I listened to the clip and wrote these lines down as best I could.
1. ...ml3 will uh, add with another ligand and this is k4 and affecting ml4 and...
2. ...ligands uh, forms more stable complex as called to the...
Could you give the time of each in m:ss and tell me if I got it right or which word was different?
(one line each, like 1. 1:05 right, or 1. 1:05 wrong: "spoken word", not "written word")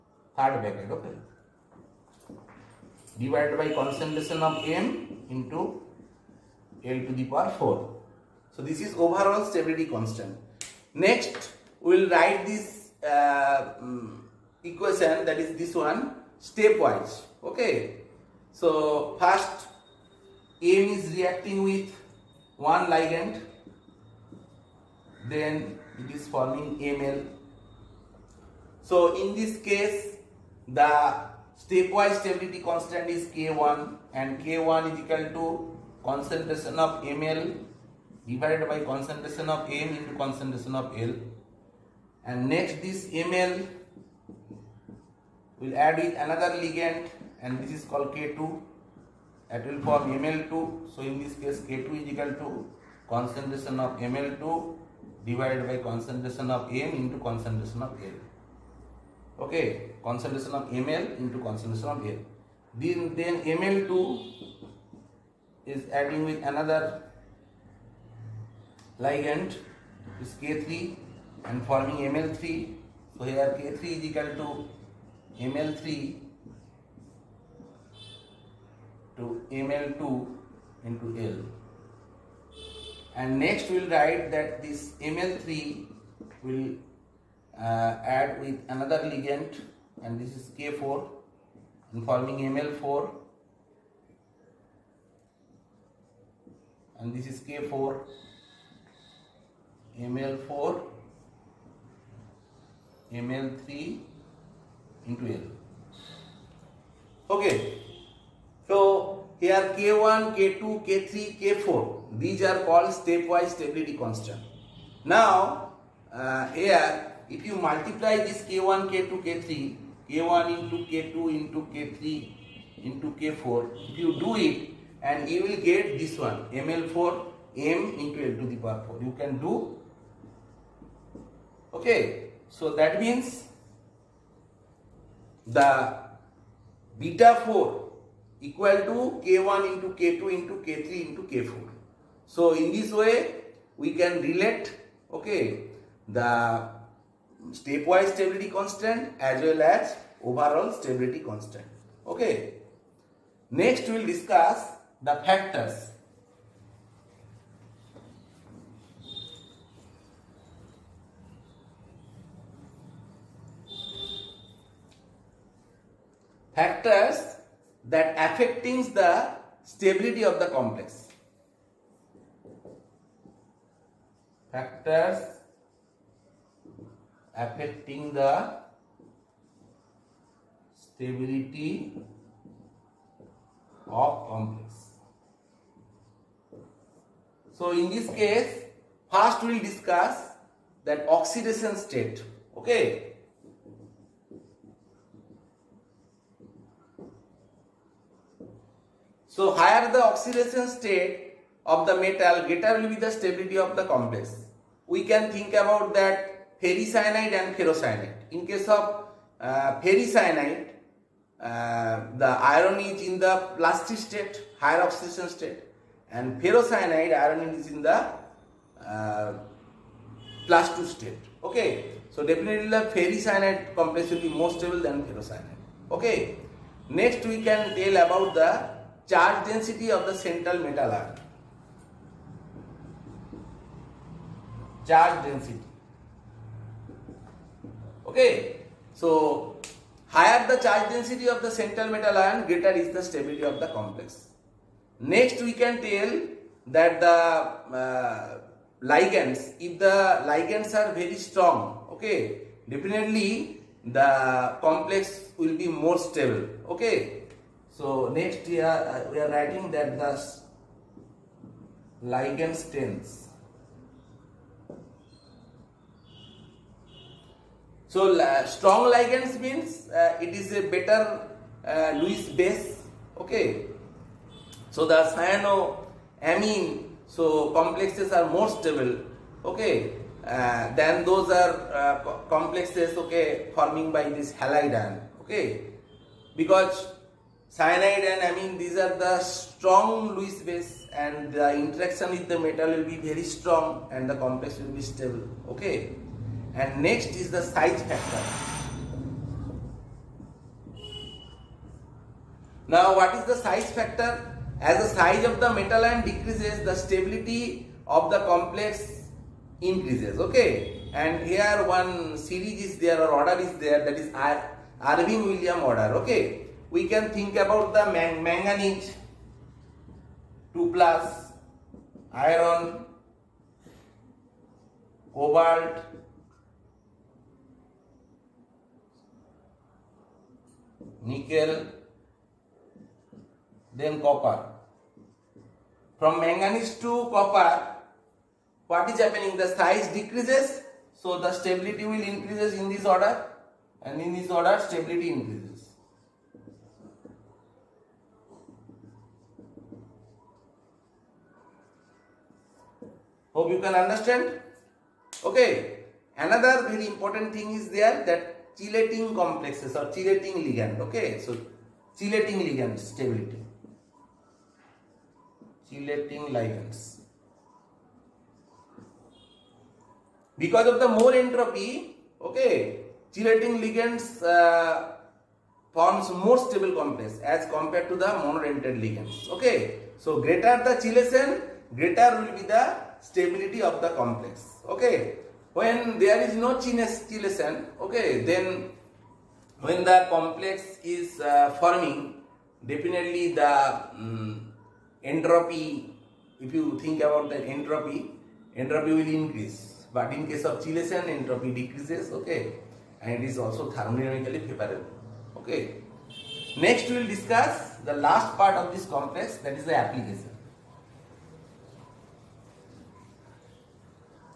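1. 1:25 wrong: "forming", not "affecting"
2. 6:13 wrong: "compared", not "called".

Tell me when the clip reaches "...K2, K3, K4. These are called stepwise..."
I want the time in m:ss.
1:50.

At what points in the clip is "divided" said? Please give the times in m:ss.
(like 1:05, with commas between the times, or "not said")
0:03, 0:38, 0:55.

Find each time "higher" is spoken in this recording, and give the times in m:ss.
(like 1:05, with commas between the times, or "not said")
3:19, 3:34, 4:00.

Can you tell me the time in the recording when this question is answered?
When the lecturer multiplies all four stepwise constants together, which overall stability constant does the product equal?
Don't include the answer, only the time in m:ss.
2:16.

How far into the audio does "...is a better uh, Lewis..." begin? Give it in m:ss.
4:30.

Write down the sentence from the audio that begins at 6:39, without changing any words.
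But in case of chelation, entropy decreases, okay, and it is also thermodynamically favorable, okay.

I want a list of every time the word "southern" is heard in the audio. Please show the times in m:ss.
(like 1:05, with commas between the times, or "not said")
not said.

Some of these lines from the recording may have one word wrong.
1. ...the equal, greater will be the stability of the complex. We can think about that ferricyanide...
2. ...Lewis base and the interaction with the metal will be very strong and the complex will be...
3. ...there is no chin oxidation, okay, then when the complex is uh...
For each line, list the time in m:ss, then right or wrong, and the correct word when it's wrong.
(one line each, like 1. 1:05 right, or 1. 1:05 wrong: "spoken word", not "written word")
1. 3:21 wrong: "metal", not "equal"
2. 4:50 right
3. 6:25 wrong: "acetylation", not "oxidation".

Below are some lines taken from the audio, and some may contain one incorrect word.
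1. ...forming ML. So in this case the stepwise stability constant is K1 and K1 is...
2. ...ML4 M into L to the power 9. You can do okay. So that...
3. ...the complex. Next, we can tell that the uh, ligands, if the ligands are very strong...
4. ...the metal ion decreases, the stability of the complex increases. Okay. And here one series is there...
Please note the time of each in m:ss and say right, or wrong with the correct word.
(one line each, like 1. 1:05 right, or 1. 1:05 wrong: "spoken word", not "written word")
1. 0:26 right
2. 2:06 wrong: "4", not "9"
3. 4:03 right
4. 5:05 right.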